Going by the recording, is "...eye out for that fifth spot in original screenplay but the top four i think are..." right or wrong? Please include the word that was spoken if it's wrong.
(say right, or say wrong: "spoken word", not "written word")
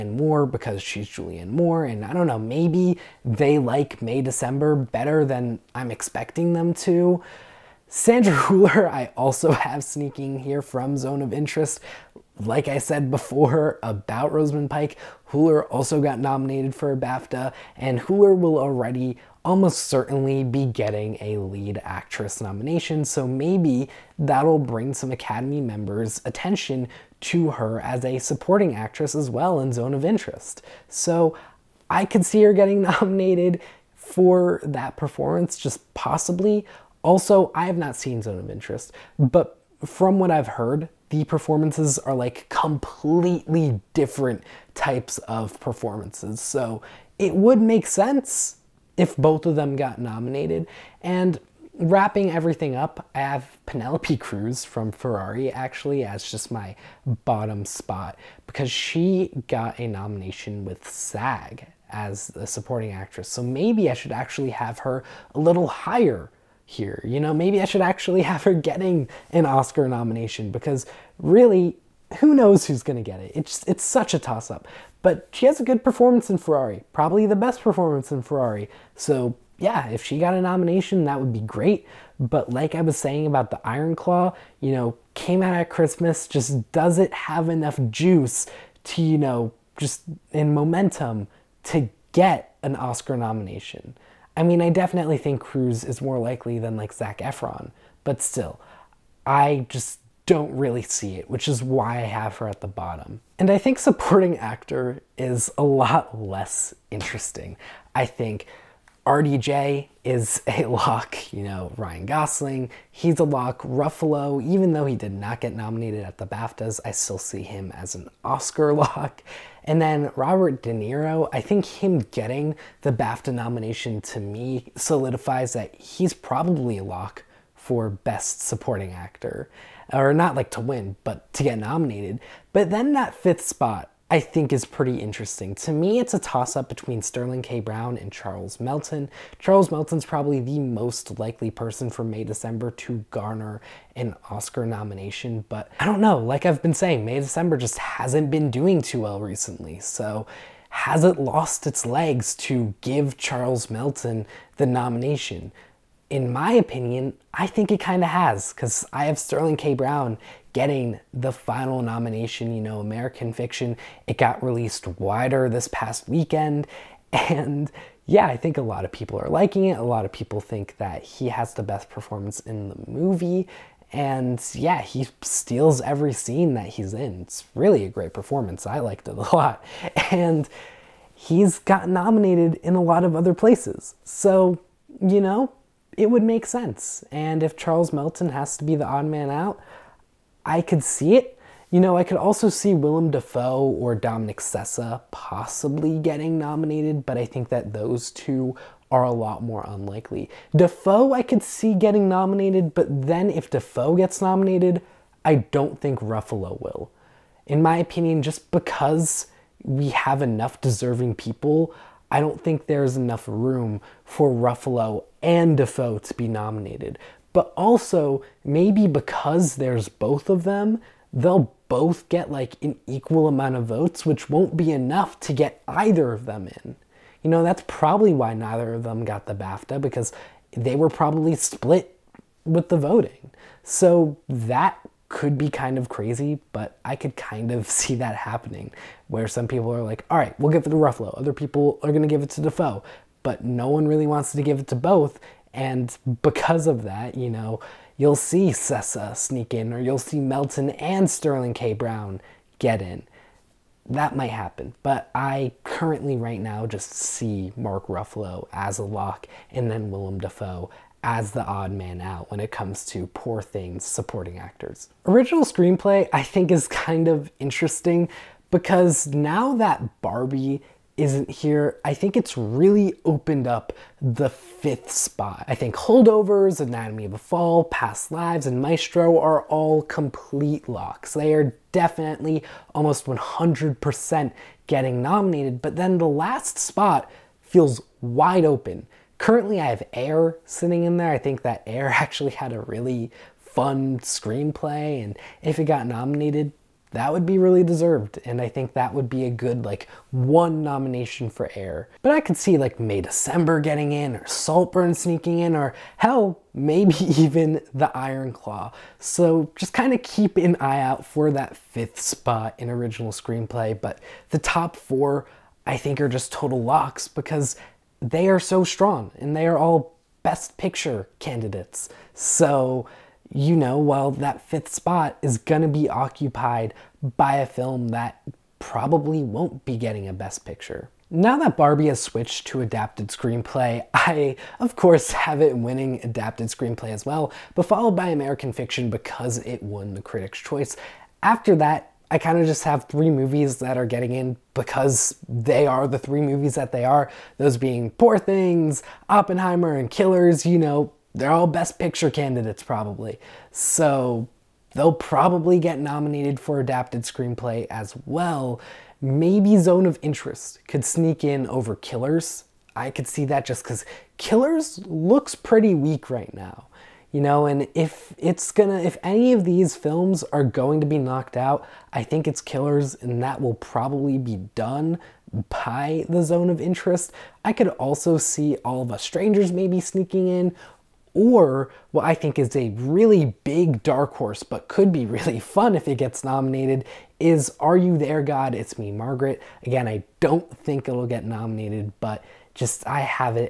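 right.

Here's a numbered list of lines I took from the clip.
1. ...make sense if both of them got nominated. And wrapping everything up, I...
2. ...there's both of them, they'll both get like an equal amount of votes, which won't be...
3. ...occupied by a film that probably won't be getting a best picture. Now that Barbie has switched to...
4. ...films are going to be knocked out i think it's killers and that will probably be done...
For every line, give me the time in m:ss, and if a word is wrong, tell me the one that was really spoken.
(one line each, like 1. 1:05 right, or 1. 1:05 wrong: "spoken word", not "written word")
1. 0:47 right
2. 3:39 right
3. 5:25 right
4. 6:09 right.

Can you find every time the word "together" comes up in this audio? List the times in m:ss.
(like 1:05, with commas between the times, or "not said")
not said.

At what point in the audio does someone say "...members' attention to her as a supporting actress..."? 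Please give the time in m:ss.
0:25.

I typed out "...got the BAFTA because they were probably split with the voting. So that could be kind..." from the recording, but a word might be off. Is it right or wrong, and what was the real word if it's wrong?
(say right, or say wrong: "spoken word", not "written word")
right.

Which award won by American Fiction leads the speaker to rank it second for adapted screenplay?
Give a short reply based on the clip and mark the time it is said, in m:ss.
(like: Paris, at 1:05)
Critics' Choice, at 5:40.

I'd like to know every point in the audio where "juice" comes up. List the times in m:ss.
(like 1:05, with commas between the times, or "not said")
1:27.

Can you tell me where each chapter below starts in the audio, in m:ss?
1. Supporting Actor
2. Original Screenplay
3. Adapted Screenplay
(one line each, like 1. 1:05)
1. 1:43
2. 4:25
3. 5:31.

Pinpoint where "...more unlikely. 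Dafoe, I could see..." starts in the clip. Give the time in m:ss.
3:19.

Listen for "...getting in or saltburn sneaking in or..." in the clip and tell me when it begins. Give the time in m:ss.
5:03.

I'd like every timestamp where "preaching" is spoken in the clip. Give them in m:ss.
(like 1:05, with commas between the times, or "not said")
not said.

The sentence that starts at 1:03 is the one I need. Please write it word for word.
So maybe I should actually have her a little higher here.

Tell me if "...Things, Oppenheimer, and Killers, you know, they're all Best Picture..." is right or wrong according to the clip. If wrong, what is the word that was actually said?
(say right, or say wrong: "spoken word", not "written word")
right.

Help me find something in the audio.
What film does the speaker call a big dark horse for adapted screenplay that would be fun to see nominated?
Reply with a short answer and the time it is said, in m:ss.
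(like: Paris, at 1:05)
Are You There, God? It's Me, Margaret, at 6:27.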